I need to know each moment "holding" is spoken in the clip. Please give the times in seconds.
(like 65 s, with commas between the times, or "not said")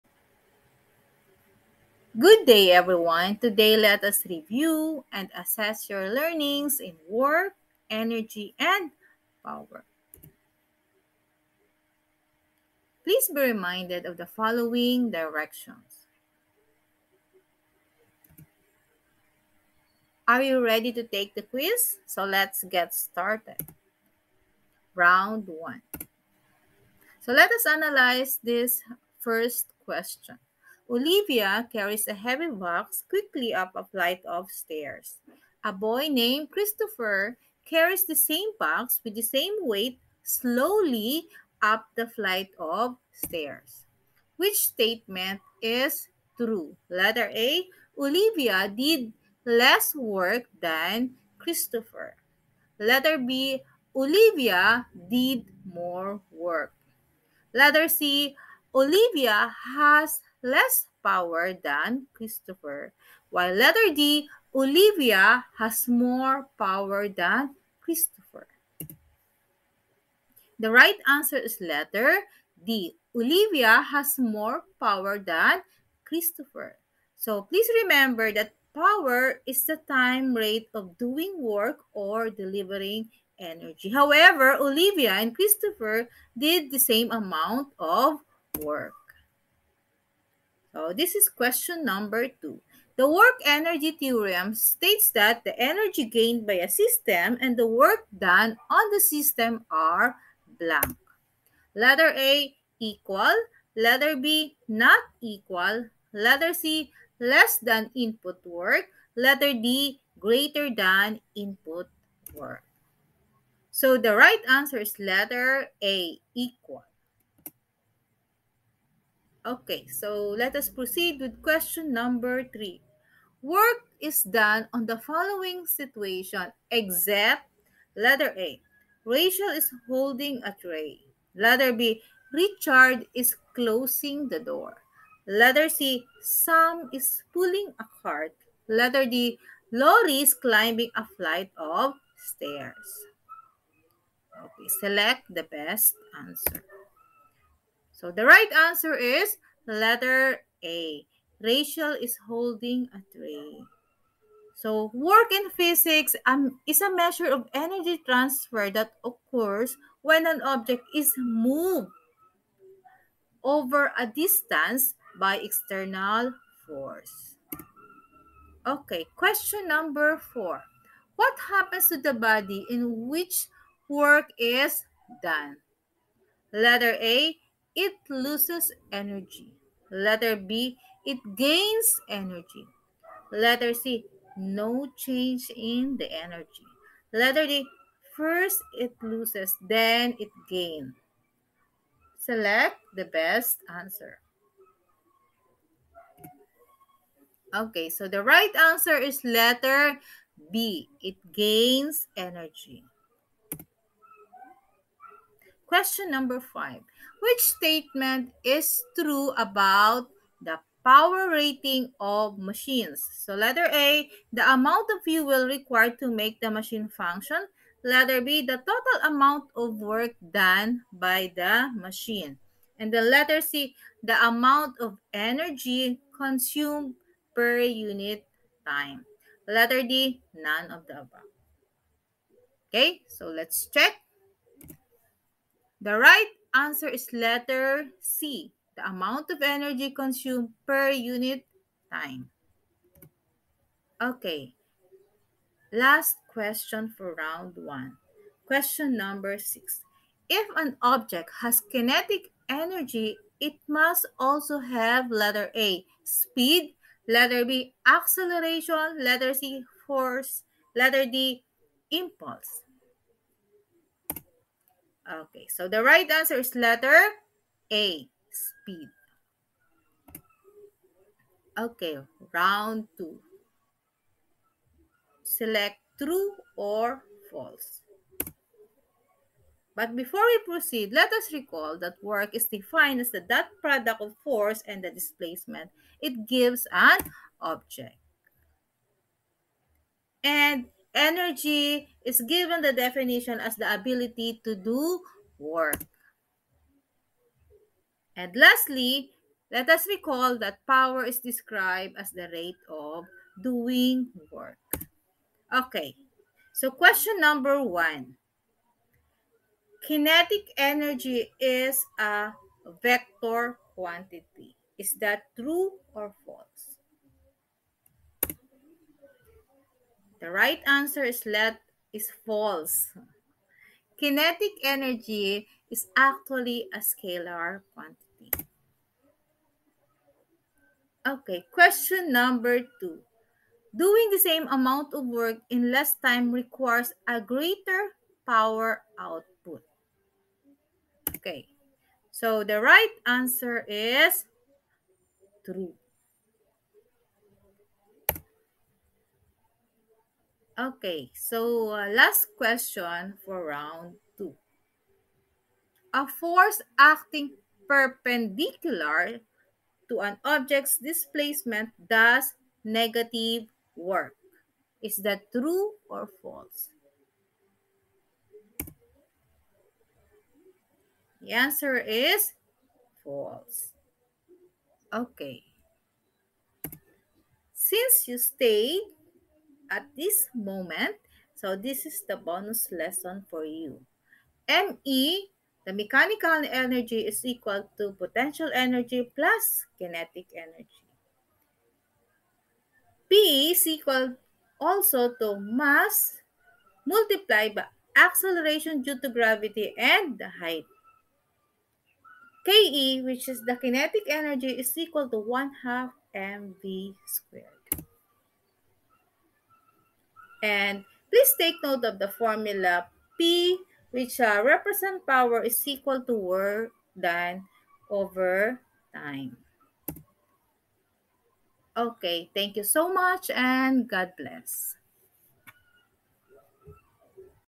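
129 s, 152 s.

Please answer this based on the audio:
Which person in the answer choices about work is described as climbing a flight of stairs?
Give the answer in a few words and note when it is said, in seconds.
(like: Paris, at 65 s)
Lori, at 139 s.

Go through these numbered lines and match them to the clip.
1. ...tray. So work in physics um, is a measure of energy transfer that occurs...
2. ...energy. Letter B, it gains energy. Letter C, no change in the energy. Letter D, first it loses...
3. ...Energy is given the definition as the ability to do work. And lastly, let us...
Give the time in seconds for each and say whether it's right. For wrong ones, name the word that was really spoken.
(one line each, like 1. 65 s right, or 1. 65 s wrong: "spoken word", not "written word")
1. 153 s right
2. 178 s right
3. 290 s right.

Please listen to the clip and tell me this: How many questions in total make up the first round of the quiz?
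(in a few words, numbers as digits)
6.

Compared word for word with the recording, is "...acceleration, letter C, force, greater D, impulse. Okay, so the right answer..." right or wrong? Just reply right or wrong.
wrong.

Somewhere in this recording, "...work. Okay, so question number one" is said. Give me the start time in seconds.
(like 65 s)
304 s.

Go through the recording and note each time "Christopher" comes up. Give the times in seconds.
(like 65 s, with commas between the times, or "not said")
36 s, 51 s, 62 s, 67 s, 76 s, 85 s.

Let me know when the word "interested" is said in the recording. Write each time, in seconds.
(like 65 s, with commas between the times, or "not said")
not said.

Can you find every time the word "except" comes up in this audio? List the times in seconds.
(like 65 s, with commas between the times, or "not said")
126 s.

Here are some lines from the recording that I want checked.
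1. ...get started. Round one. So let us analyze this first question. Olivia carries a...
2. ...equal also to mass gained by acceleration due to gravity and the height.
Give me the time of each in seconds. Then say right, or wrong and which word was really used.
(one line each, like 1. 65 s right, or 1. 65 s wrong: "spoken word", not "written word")
1. 22 s right
2. 393 s wrong: "multiplied", not "gained".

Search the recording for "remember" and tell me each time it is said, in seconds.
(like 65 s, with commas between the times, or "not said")
77 s.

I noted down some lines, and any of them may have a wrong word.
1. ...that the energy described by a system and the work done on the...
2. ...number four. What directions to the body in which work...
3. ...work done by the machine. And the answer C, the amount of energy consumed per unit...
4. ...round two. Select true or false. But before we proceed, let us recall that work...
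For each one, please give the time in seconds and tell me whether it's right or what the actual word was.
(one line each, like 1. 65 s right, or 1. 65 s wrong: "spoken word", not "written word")
1. 95 s wrong: "gained", not "described"
2. 169 s wrong: "happens", not "directions"
3. 219 s wrong: "letter", not "answer"
4. 272 s right.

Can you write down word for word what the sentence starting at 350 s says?
Okay, so uh, last question for round two.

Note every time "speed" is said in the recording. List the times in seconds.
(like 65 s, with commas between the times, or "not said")
256 s, 268 s.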